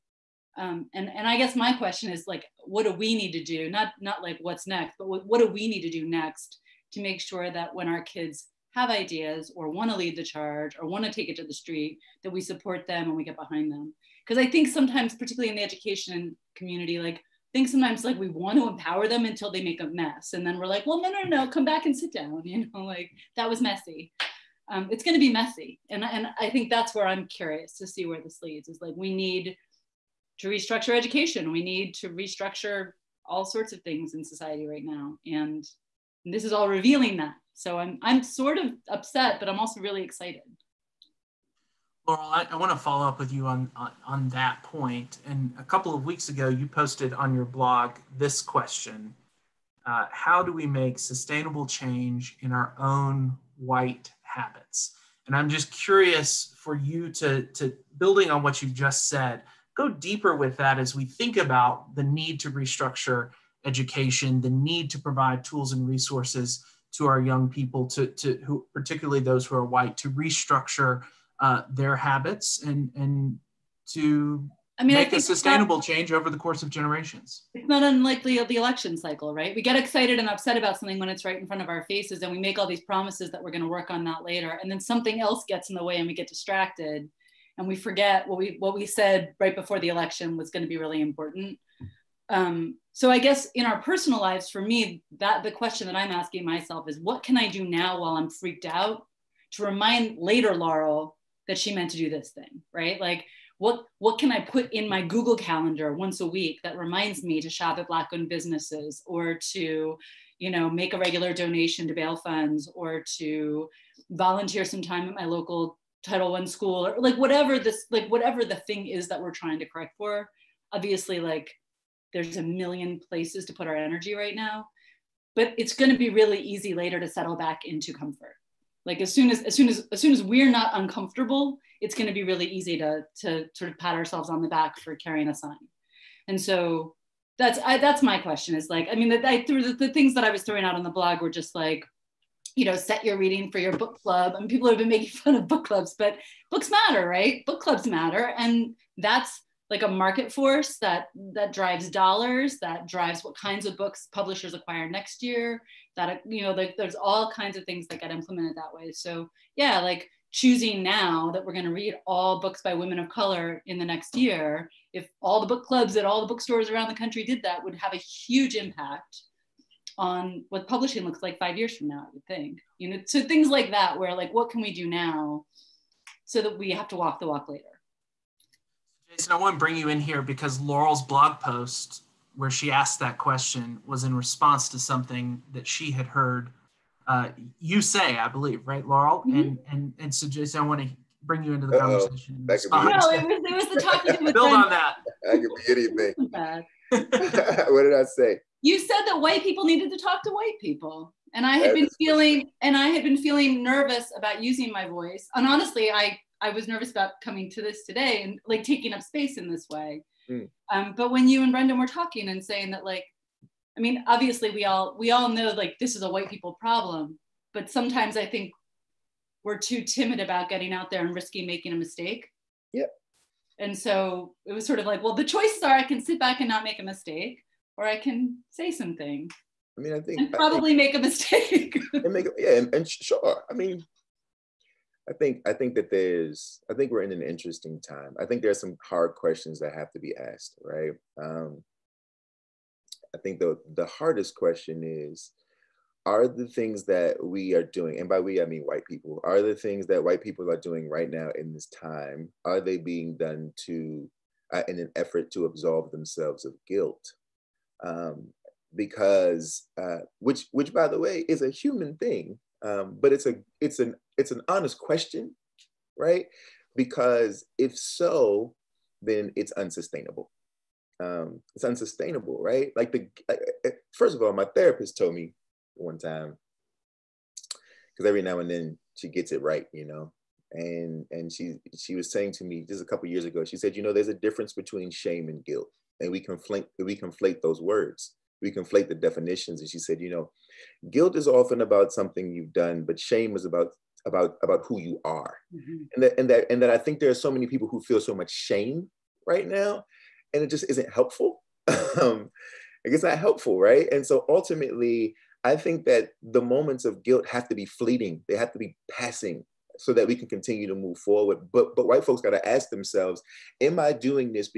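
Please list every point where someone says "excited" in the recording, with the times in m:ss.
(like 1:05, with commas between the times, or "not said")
0:40, 1:19.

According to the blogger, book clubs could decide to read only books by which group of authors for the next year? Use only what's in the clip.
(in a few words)
women of color.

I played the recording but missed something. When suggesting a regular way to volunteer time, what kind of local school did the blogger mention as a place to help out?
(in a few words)
Title One school.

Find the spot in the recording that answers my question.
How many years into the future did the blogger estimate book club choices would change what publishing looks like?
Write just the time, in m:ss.
2:51.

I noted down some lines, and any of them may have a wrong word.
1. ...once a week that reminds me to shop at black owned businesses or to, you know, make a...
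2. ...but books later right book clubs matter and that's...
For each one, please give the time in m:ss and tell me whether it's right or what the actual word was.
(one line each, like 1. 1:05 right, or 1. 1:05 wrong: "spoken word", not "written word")
1. 1:45 right
2. 2:25 wrong: "matter", not "later".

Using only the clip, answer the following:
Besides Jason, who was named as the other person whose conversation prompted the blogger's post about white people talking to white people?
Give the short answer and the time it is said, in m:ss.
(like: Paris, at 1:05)
Brendan, at 3:31.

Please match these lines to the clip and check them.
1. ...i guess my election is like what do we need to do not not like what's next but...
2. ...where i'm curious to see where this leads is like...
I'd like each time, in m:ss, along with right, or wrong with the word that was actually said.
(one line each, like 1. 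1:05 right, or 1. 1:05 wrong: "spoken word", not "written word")
1. 0:01 wrong: "question", not "election"
2. 0:26 right.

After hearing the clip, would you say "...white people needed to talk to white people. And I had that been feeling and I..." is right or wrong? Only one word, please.
right.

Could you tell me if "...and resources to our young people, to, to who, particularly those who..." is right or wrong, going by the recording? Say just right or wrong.
right.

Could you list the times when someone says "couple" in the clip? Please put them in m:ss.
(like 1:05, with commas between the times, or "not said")
0:45, 4:42.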